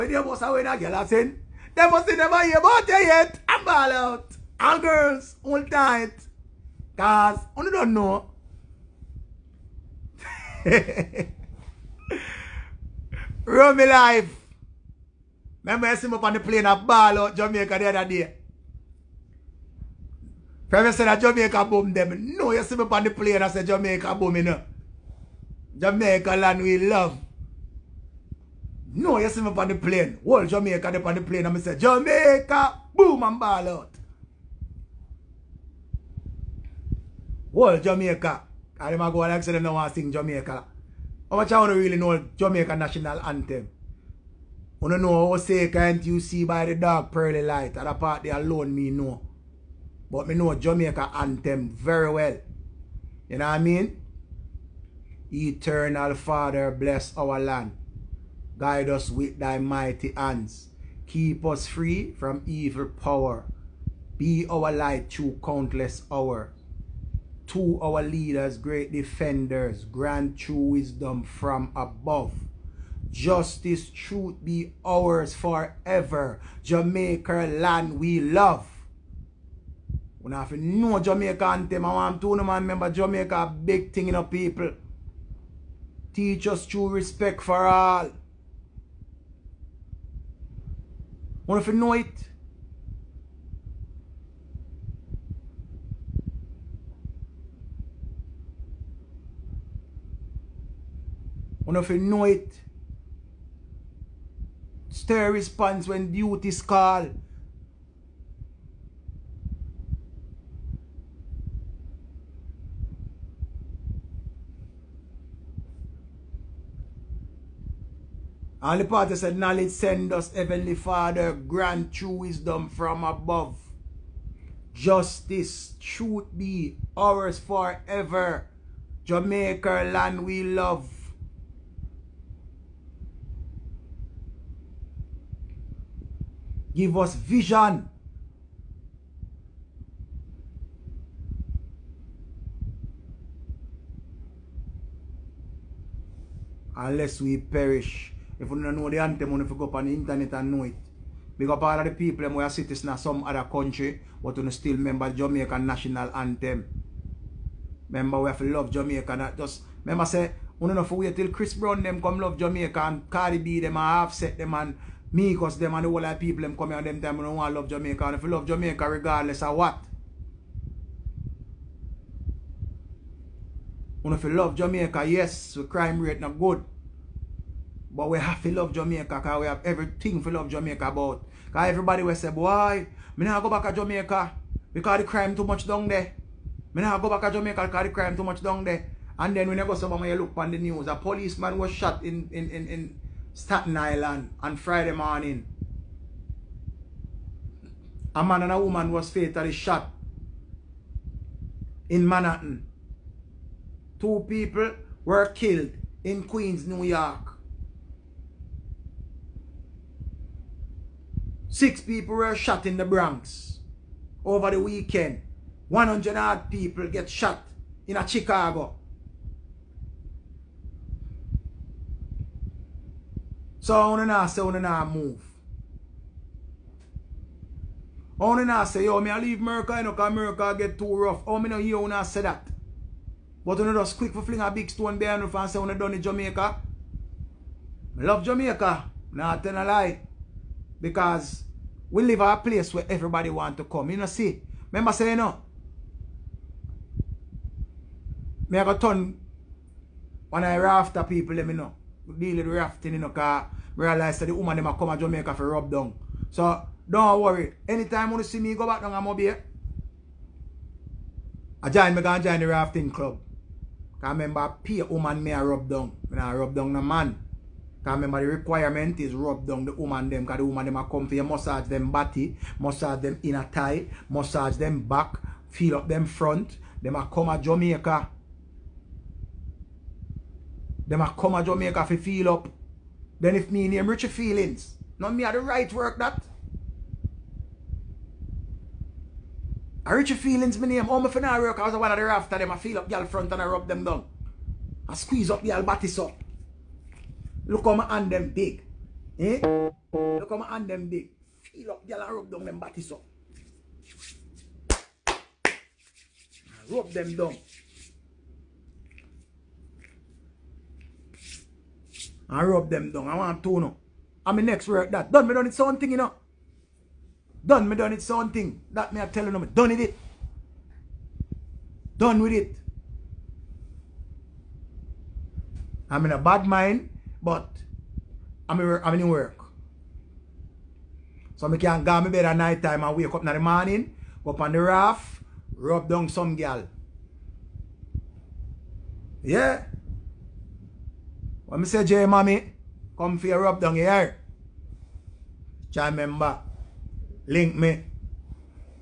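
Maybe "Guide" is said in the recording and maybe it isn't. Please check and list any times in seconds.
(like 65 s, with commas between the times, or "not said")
58 s.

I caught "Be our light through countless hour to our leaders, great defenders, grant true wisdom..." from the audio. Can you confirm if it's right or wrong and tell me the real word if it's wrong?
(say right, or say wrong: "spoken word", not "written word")
right.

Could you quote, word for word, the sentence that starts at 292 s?
I feel up y'all front and I rub them down.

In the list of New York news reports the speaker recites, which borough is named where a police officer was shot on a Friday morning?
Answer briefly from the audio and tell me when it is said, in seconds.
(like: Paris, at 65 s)
Staten Island, at 193 s.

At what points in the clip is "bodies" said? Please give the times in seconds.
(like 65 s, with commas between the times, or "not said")
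295 s, 302 s.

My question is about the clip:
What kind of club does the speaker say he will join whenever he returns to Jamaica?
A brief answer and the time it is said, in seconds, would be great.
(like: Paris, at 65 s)
rafting club, at 262 s.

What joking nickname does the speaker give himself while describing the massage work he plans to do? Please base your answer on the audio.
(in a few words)
Richie Feelings.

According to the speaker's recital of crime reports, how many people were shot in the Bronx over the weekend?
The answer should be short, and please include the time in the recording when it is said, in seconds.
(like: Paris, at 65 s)
6, at 211 s.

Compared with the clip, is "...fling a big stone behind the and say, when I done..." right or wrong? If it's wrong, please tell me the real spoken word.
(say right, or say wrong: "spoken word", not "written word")
right.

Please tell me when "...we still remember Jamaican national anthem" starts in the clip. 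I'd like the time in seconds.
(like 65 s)
154 s.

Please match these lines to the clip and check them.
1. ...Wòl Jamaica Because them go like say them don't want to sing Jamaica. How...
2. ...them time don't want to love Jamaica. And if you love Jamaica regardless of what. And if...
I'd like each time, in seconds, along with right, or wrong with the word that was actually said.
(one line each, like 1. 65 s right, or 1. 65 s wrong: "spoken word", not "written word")
1. 37 s right
2. 166 s right.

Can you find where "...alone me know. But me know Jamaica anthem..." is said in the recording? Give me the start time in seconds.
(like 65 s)
48 s.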